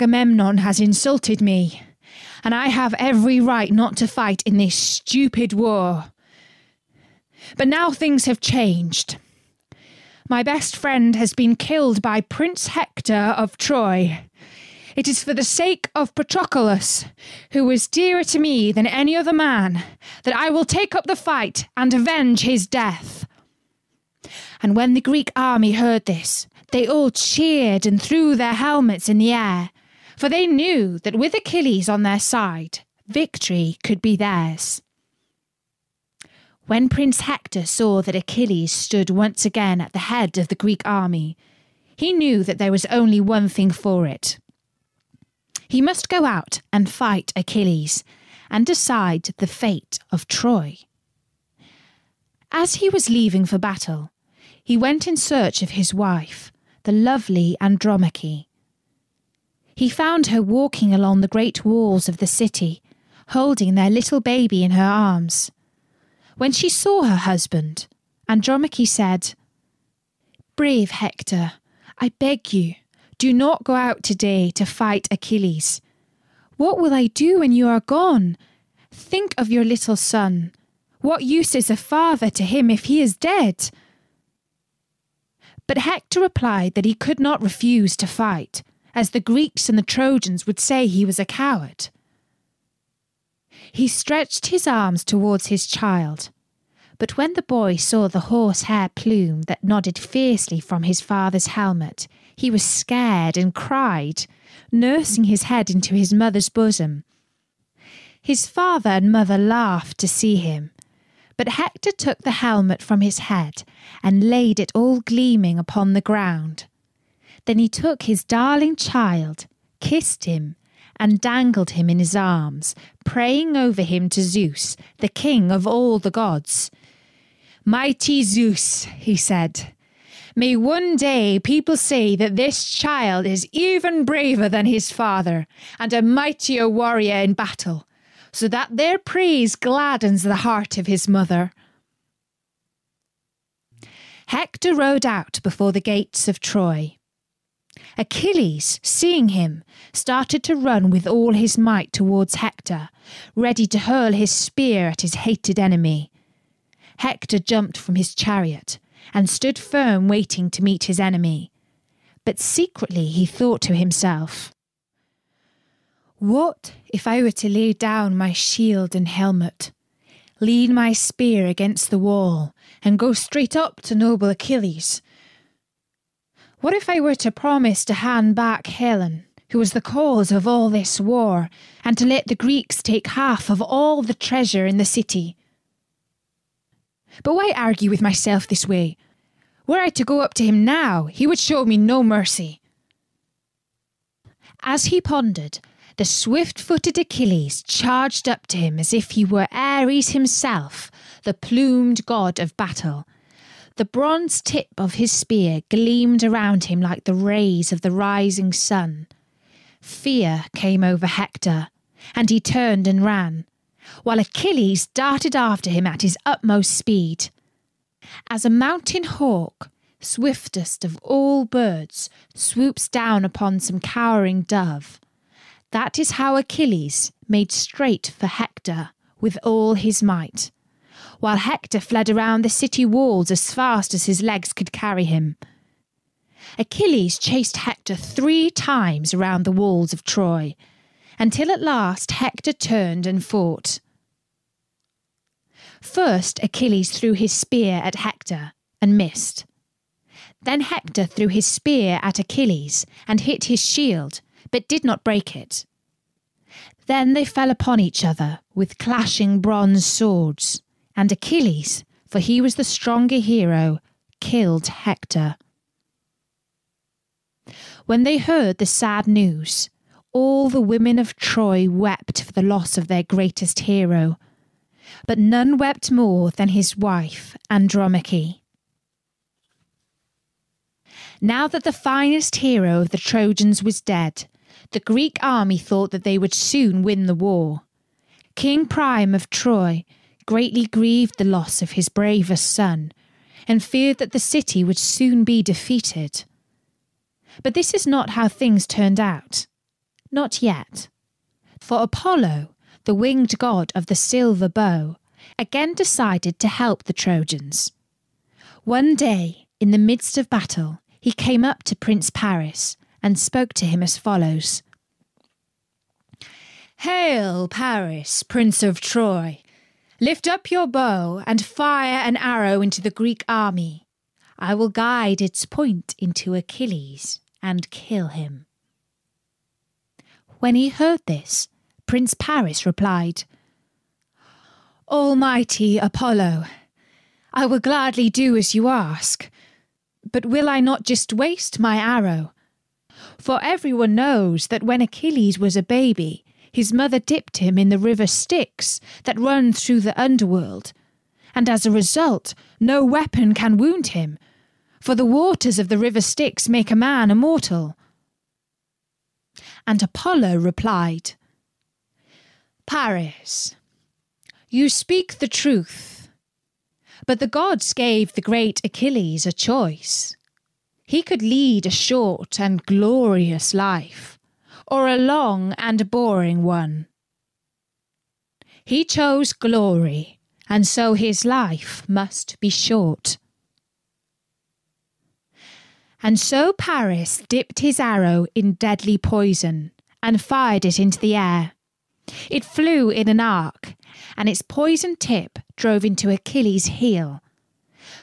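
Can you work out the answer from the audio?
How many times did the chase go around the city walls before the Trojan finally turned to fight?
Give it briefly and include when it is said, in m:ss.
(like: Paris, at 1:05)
3, at 3:57.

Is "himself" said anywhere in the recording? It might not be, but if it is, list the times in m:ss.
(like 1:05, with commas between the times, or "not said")
2:43, 3:20.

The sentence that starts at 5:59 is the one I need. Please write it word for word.
And Apollo replied, Paris, you speak the truth, but the gods gave the great Achilles a choice.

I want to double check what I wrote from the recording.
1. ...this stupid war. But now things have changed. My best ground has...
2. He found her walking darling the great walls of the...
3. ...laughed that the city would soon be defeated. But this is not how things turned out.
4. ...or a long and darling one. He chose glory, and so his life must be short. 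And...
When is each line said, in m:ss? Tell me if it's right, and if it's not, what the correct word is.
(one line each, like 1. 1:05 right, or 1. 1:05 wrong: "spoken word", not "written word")
1. 0:04 wrong: "friend", not "ground"
2. 0:59 wrong: "along", not "darling"
3. 4:53 wrong: "feared", not "laughed"
4. 6:14 wrong: "boring", not "darling".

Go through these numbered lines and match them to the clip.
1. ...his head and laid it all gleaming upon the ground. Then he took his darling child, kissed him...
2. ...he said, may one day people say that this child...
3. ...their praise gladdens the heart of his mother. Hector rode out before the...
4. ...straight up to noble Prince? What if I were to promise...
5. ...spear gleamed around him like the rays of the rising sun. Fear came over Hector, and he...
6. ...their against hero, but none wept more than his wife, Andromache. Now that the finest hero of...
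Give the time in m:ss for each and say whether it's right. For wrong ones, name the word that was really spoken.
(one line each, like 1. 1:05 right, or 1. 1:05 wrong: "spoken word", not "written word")
1. 1:53 right
2. 2:08 right
3. 2:18 right
4. 2:53 wrong: "Achilles", not "Prince"
5. 3:25 right
6. 4:32 wrong: "greatest", not "against".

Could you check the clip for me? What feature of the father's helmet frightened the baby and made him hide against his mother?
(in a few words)
horsehair plume.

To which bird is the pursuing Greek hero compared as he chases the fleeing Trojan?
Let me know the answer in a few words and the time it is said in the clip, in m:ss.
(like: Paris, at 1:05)
mountain hawk, at 3:38.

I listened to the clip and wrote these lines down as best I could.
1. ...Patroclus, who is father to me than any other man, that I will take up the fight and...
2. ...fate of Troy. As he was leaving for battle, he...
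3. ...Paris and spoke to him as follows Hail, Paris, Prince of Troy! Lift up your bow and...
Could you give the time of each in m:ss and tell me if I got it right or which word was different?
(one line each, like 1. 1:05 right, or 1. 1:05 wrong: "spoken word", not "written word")
1. 0:16 wrong: "dearer", not "father"
2. 0:49 right
3. 5:12 right.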